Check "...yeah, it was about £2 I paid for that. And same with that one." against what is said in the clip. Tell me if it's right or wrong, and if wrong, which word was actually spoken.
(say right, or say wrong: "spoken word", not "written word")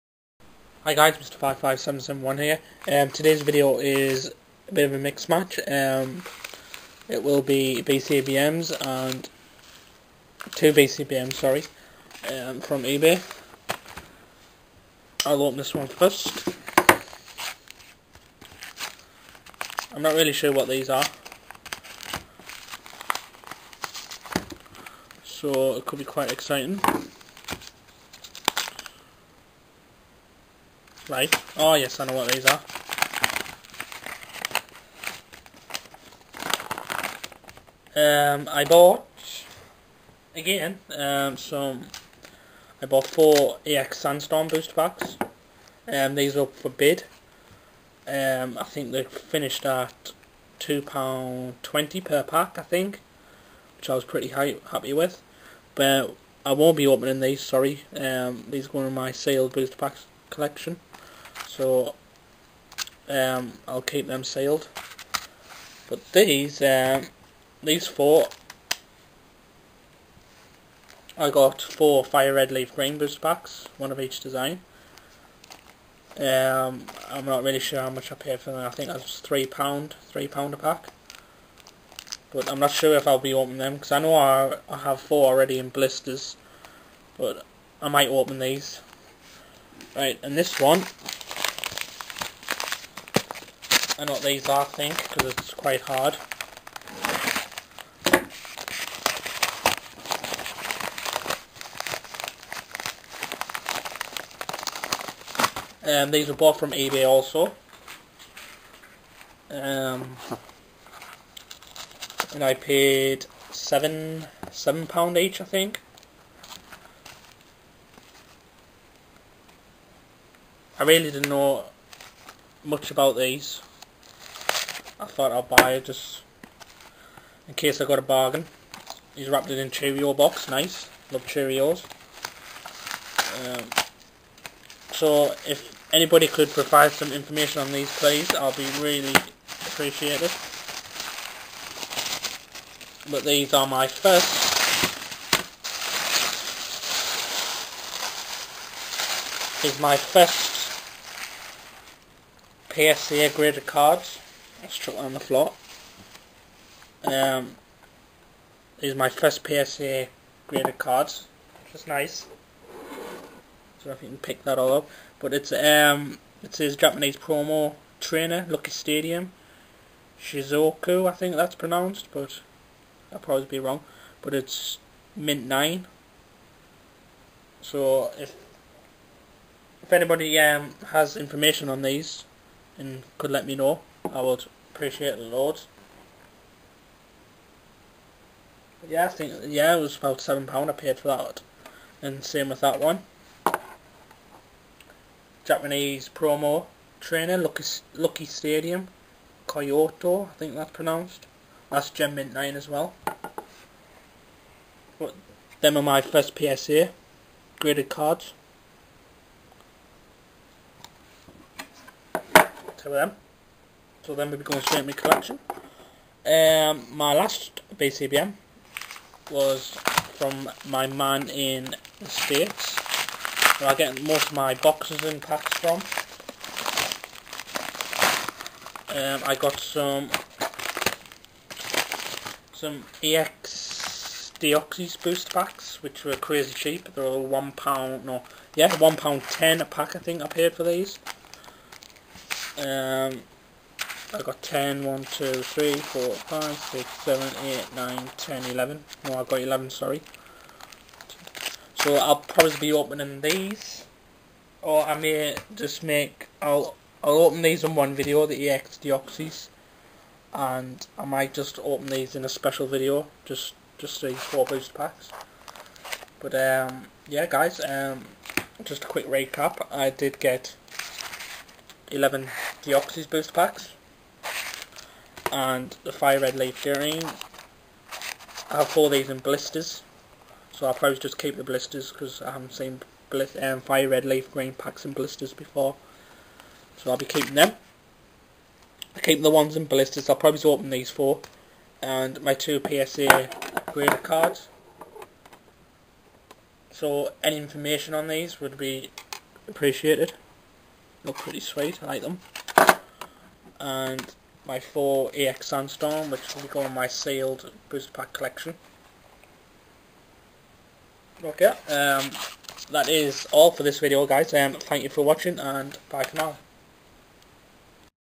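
wrong: "7", not "2".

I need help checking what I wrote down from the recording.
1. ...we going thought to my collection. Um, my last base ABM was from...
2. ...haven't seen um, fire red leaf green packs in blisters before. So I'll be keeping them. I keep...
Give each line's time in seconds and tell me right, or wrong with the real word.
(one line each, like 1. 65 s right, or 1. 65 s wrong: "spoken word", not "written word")
1. 214 s wrong: "straight", not "thought"
2. 282 s right.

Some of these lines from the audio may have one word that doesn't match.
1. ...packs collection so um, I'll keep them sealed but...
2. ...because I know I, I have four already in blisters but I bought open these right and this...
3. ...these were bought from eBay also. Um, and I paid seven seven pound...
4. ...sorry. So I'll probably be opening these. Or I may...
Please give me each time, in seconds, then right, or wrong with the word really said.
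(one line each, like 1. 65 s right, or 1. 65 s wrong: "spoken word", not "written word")
1. 59 s right
2. 83 s wrong: "might", not "bought"
3. 106 s right
4. 249 s right.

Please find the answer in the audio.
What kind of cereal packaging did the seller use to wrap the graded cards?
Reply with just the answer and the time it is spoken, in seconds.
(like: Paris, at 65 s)
Cheerio box, at 129 s.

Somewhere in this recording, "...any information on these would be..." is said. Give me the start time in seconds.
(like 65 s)
297 s.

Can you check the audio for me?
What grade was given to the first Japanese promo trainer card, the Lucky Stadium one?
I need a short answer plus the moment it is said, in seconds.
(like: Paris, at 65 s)
Mint 9, at 175 s.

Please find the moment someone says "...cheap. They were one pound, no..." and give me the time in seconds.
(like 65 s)
236 s.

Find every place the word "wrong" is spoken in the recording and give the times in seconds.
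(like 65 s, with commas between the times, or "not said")
173 s.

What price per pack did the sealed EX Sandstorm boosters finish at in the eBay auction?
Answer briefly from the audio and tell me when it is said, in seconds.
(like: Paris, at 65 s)
£2.20, at 50 s.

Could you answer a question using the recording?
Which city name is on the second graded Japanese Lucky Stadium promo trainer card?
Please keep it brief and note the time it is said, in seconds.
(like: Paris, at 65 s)
Kyoto, at 199 s.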